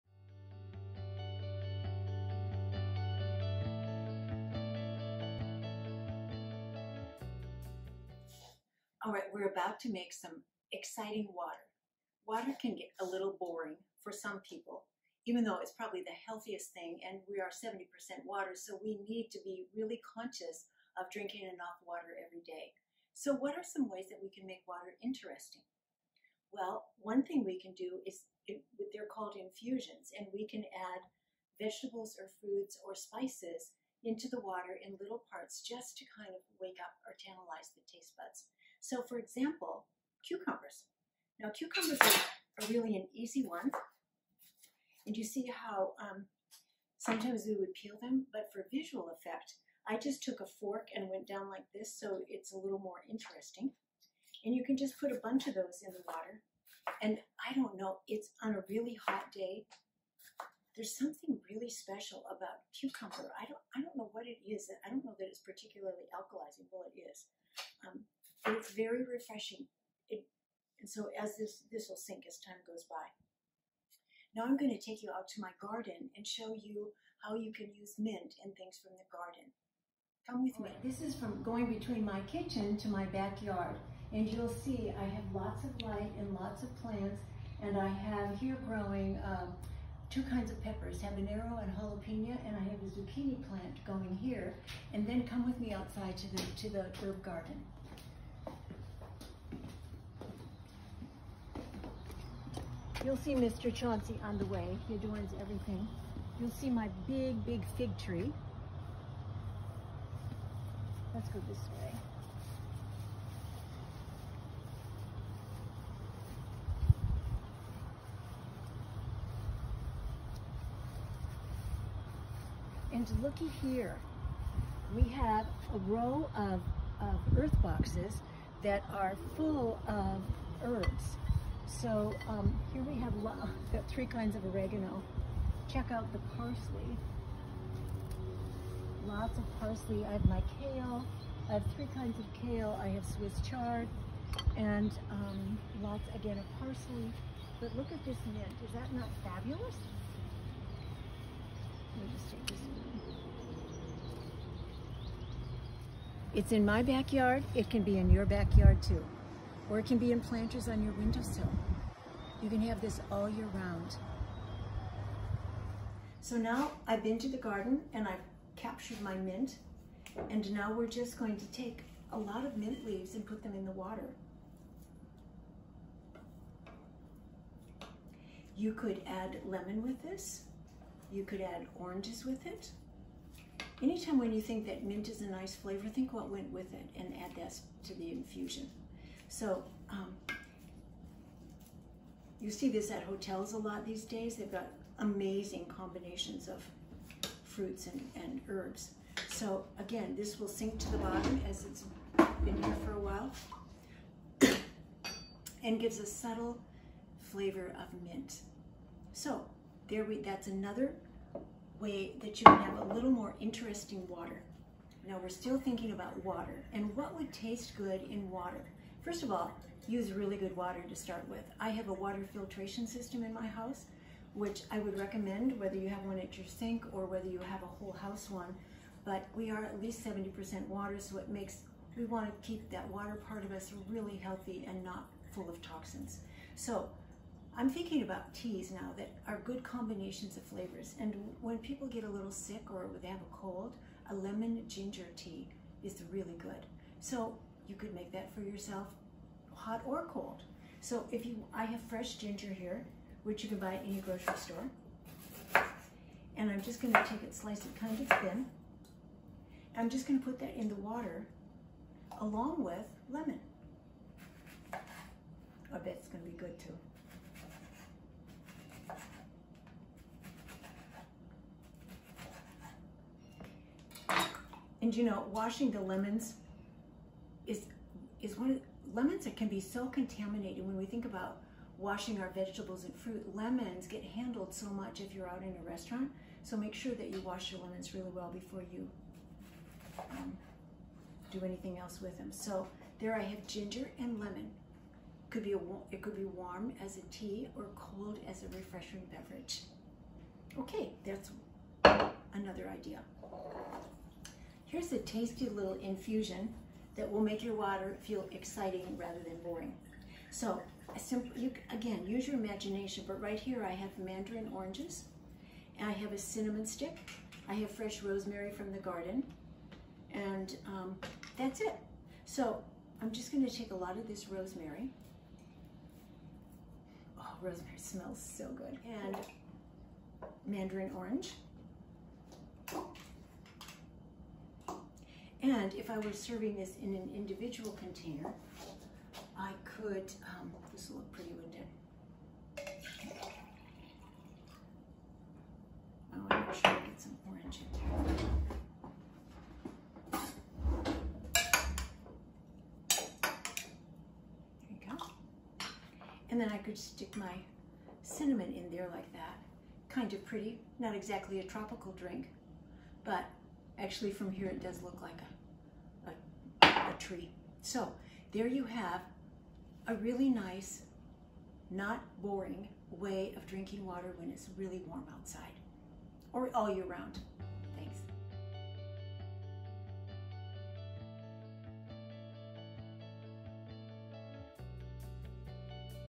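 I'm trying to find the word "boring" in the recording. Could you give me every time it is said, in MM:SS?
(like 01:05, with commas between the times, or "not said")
00:13, 05:09, 06:12.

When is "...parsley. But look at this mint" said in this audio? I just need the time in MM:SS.
02:26.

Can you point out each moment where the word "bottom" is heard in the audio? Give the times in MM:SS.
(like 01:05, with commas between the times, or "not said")
03:20.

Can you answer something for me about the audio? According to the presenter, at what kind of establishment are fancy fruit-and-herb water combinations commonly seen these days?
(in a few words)
Hotels.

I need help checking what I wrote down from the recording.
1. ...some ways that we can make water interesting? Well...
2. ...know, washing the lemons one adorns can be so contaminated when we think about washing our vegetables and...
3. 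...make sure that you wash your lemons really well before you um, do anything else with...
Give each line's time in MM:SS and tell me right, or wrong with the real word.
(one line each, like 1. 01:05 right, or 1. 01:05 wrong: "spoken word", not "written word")
1. 00:23 right
2. 04:35 wrong: "lemons", not "adorns"
3. 04:46 right.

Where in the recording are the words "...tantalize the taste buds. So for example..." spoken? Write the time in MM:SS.
00:37.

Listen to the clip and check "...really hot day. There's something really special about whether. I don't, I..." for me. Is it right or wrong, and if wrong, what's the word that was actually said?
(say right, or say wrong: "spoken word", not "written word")
wrong: "cucumber", not "whether".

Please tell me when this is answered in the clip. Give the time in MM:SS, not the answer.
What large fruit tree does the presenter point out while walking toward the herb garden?
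01:47.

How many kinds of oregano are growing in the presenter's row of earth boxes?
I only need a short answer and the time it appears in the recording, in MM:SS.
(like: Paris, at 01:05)
3, at 02:13.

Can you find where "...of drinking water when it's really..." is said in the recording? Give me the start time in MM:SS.
06:13.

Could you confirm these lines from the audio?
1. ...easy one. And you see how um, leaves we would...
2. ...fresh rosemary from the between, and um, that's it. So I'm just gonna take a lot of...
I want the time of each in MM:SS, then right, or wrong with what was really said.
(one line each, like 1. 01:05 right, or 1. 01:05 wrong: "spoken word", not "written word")
1. 00:43 wrong: "sometimes", not "leaves"
2. 05:17 wrong: "garden", not "between".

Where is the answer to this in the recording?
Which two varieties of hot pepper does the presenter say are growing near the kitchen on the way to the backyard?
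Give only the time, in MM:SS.
01:30.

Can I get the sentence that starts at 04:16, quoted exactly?
And I'm just gonna take it, slice it kind of thin.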